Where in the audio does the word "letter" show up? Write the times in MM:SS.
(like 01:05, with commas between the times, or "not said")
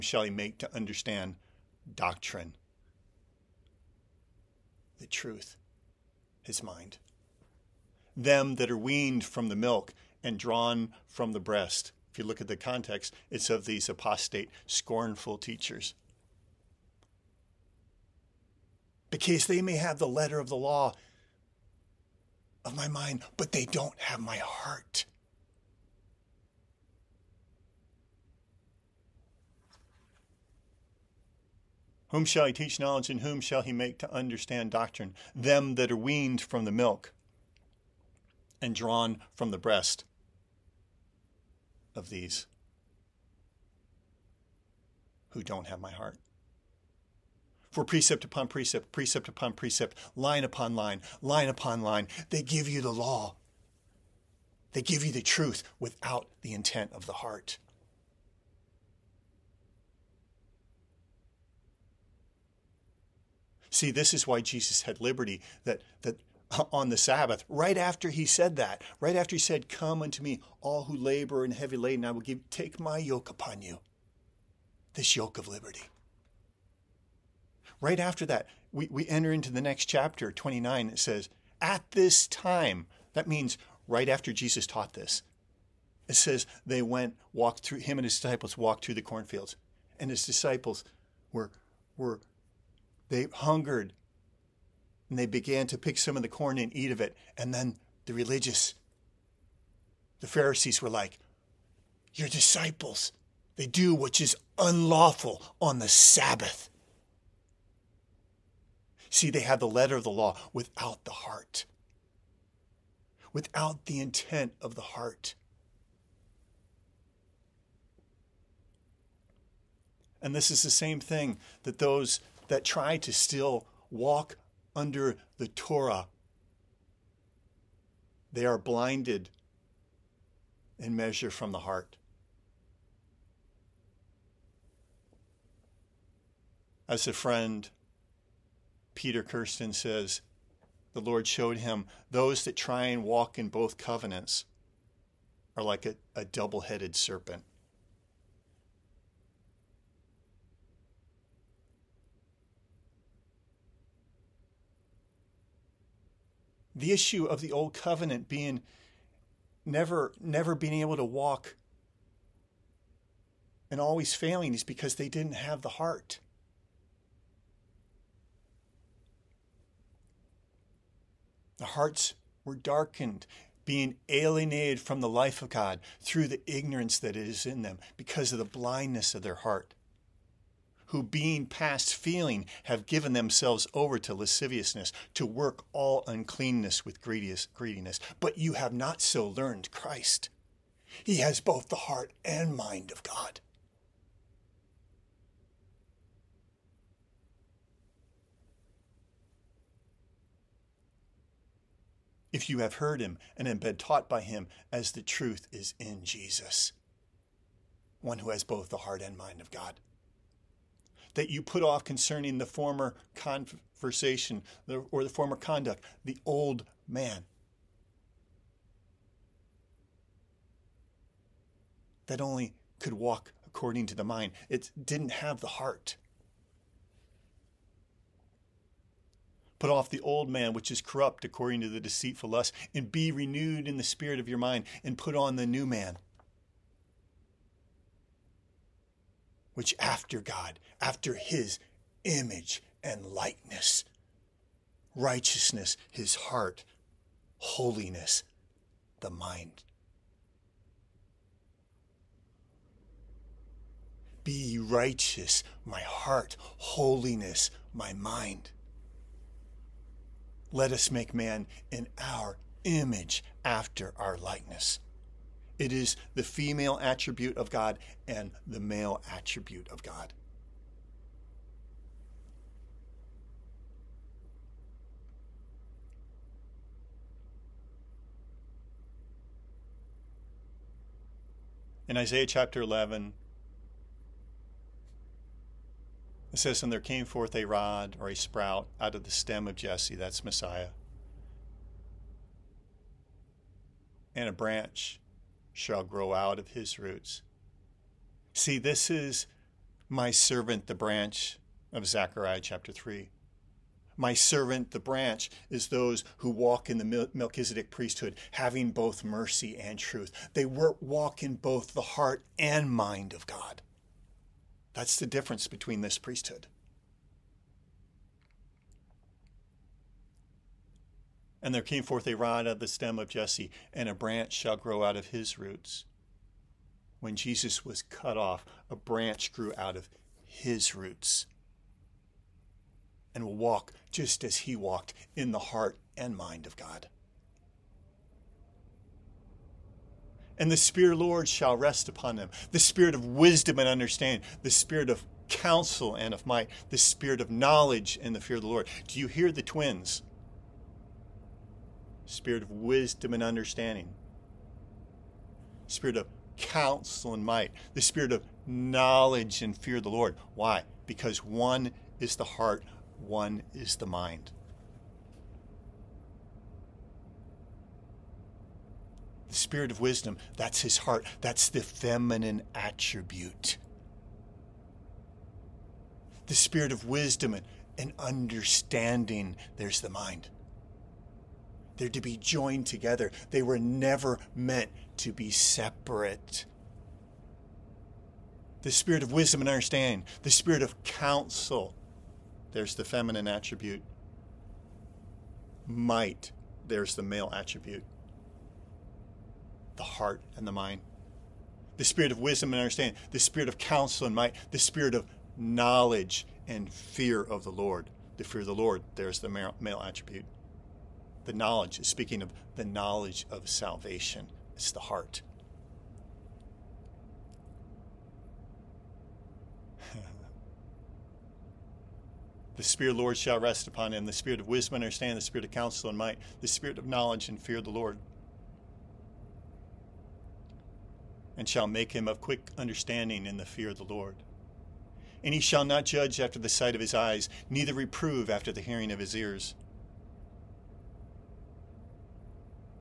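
00:20, 01:49.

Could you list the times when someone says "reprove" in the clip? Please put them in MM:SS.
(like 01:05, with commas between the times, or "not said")
07:17.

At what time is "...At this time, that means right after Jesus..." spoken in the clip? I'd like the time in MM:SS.
01:21.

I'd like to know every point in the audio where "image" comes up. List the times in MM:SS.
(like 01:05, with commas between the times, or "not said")
04:02, 04:22.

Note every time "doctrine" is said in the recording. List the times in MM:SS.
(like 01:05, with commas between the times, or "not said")
00:01, 00:34.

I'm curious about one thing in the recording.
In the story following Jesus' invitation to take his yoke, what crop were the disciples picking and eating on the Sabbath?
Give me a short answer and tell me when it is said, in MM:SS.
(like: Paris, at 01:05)
corn, at 01:36.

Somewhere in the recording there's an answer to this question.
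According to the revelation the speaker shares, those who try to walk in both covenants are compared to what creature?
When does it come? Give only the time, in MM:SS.
02:26.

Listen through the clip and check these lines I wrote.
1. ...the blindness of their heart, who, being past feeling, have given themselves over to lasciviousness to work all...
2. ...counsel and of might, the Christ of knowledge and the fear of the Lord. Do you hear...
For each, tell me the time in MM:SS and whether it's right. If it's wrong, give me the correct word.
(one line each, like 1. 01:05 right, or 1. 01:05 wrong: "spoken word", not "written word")
1. 02:58 right
2. 05:45 wrong: "Spirit", not "Christ".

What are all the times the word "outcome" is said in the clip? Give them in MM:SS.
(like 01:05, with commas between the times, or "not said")
not said.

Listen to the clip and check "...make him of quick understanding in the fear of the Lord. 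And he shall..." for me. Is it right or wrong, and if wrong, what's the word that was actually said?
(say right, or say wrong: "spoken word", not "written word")
right.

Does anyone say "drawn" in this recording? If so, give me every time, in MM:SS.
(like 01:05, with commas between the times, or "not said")
00:10, 00:38.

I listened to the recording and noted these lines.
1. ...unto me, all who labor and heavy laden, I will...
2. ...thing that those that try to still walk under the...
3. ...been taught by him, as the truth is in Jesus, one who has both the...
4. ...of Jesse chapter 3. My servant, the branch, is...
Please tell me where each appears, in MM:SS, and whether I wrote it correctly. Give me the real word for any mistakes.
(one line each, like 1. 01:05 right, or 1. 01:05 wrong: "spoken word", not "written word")
1. 01:10 right
2. 02:01 right
3. 03:23 right
4. 05:01 wrong: "Zechariah", not "Jesse".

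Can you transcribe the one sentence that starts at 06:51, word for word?
The knowledge, speaking of the knowledge of salvation, it's the heart.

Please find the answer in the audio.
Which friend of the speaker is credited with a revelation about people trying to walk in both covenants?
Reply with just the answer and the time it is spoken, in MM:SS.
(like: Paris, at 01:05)
Peter Kirsten, at 02:18.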